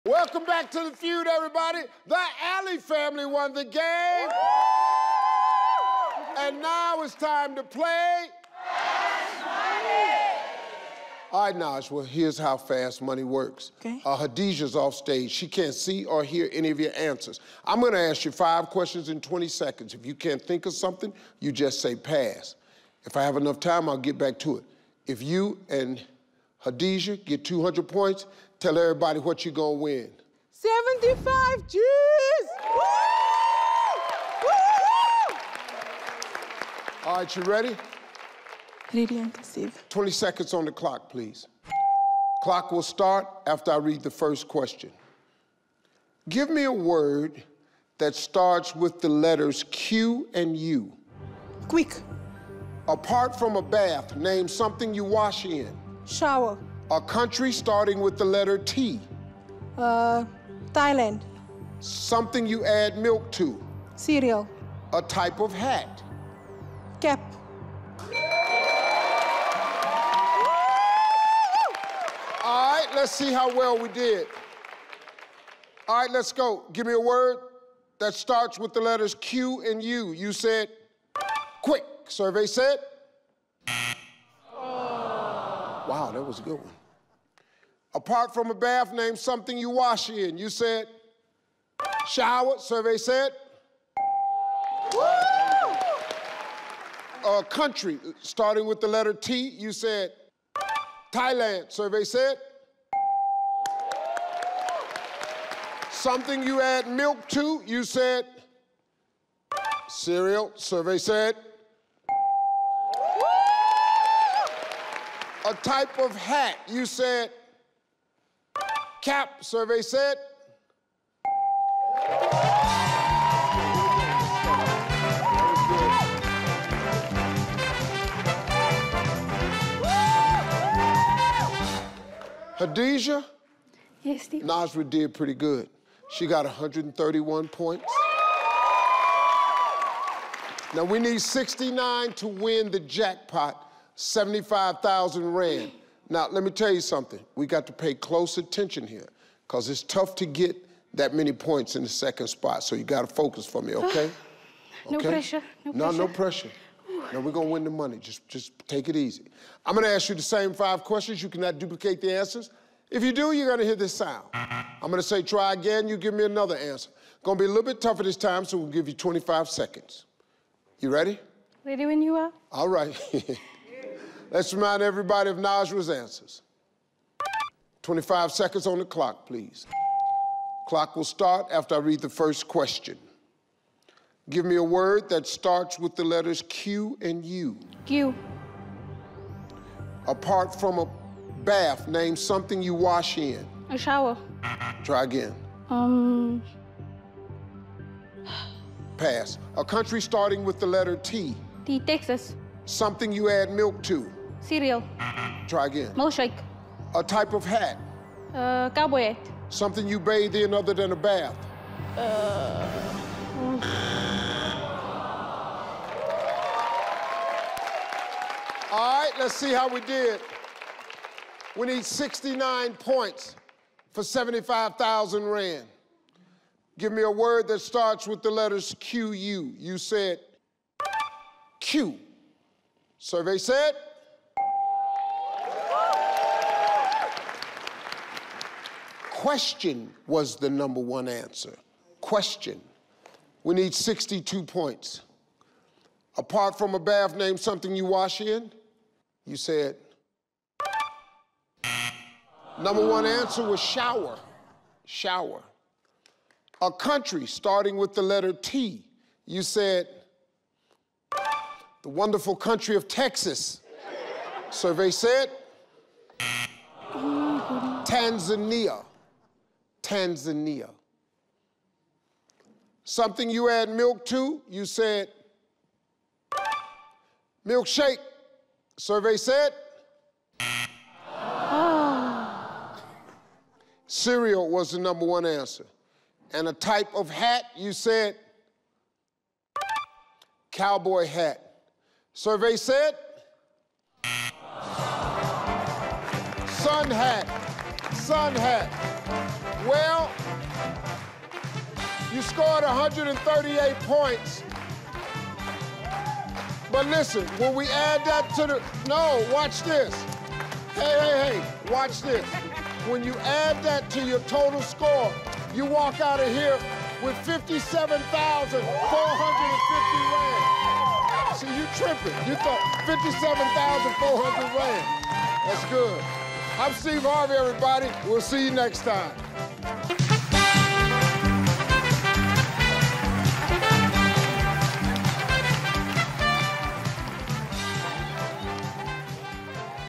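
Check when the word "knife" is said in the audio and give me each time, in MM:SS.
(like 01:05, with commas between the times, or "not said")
not said.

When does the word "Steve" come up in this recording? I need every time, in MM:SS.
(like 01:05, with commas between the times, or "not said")
02:14, 05:26.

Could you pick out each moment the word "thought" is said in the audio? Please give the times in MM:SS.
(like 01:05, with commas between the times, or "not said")
05:22.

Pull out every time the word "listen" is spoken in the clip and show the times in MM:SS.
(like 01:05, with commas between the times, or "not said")
05:06.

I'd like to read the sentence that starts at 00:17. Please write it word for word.
I'm going to ask you five questions in 20 seconds.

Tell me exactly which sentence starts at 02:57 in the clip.
25 seconds on the clock, please.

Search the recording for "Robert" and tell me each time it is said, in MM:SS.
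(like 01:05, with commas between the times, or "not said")
not said.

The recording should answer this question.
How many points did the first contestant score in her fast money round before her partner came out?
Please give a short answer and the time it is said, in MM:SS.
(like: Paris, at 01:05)
131, at 02:16.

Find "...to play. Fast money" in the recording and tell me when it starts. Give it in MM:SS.
00:07.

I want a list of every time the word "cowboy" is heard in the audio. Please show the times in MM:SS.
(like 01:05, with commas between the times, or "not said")
03:28, 04:50.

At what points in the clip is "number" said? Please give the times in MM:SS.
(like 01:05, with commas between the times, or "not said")
04:00, 04:12, 04:44.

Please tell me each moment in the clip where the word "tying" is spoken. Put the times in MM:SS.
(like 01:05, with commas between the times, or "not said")
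not said.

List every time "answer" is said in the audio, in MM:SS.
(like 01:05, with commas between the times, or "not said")
00:16, 02:42, 02:46, 02:55, 04:01, 04:13, 04:45.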